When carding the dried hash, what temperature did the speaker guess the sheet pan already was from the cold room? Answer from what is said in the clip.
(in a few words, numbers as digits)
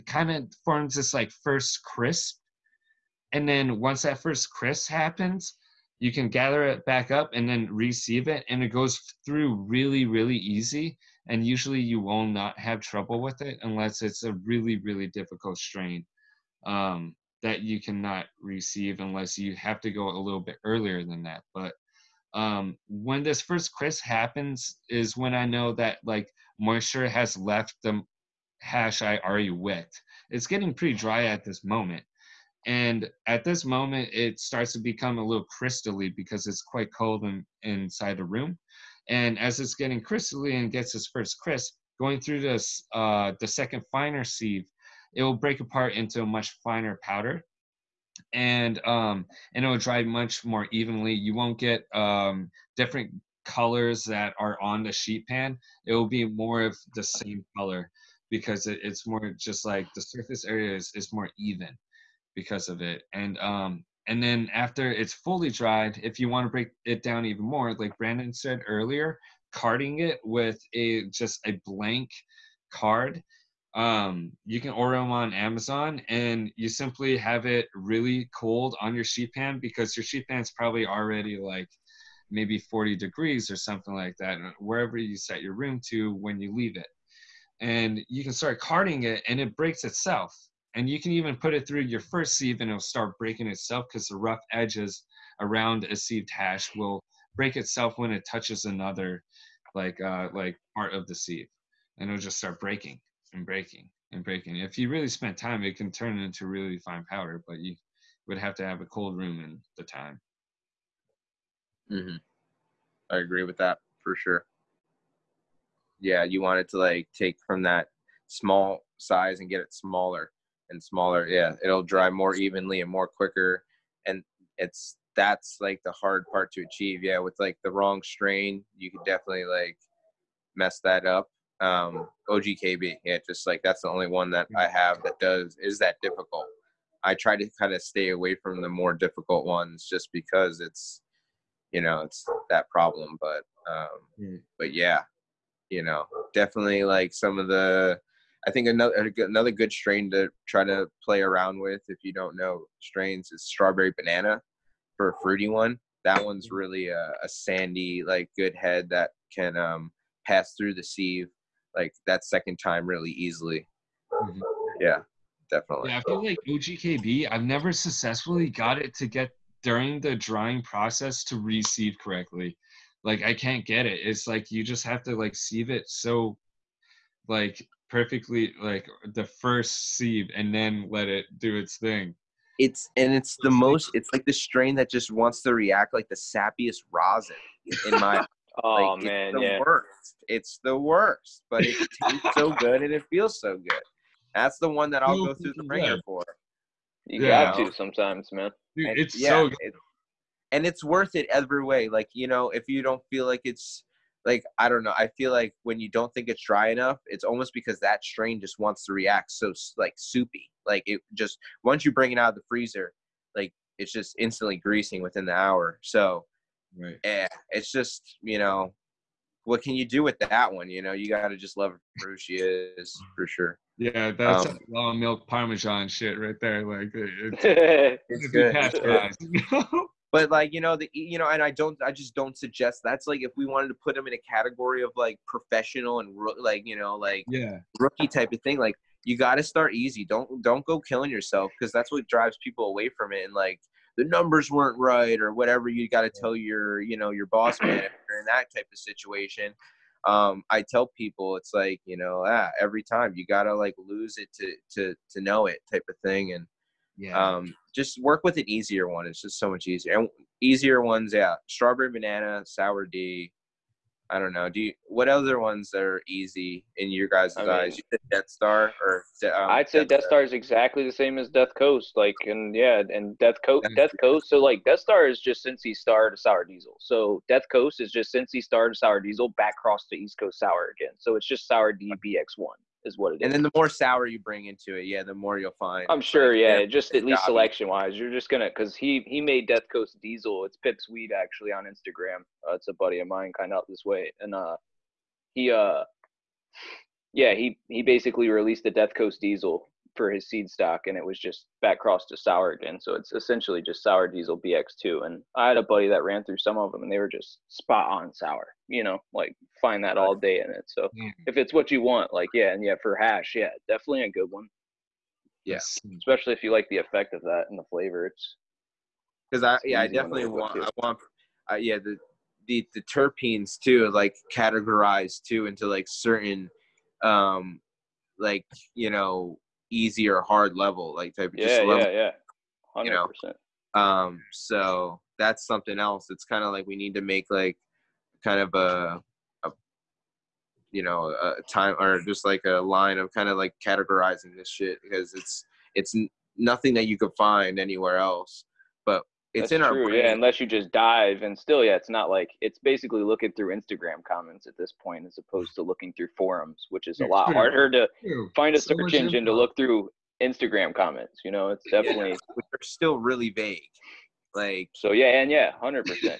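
40 degrees.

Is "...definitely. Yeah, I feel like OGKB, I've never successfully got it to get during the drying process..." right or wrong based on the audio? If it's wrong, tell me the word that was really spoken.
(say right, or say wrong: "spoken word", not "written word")
right.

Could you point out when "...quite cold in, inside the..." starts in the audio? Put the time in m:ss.
0:36.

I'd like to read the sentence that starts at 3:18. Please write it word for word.
Dude, and it's yeah, so good.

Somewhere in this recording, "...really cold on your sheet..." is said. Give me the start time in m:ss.
1:17.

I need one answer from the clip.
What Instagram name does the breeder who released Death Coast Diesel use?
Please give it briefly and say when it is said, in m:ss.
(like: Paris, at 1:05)
Pip's Weed, at 4:50.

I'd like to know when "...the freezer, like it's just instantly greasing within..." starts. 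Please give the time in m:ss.
3:32.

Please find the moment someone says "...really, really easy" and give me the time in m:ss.
0:09.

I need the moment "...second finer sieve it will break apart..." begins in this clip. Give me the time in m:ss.
0:43.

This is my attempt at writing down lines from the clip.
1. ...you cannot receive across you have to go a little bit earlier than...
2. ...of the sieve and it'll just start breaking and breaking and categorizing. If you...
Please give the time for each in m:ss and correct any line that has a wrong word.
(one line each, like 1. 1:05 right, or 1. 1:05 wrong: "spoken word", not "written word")
1. 0:17 wrong: "unless", not "across"
2. 1:40 wrong: "breaking", not "categorizing".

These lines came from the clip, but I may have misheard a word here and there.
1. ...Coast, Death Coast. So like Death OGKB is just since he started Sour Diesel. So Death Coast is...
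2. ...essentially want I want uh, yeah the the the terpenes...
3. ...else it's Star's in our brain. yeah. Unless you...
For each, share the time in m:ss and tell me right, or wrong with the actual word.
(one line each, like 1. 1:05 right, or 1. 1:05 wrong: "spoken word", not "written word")
1. 4:33 wrong: "Star", not "OGKB"
2. 5:19 wrong: "definitely", not "essentially"
3. 5:47 wrong: "That", not "Star".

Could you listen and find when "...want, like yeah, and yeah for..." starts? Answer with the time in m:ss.
5:11.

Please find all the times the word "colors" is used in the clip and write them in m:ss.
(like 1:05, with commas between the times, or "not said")
0:53, 0:57.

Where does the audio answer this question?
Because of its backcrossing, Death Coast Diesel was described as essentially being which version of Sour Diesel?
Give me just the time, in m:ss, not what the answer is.
5:03.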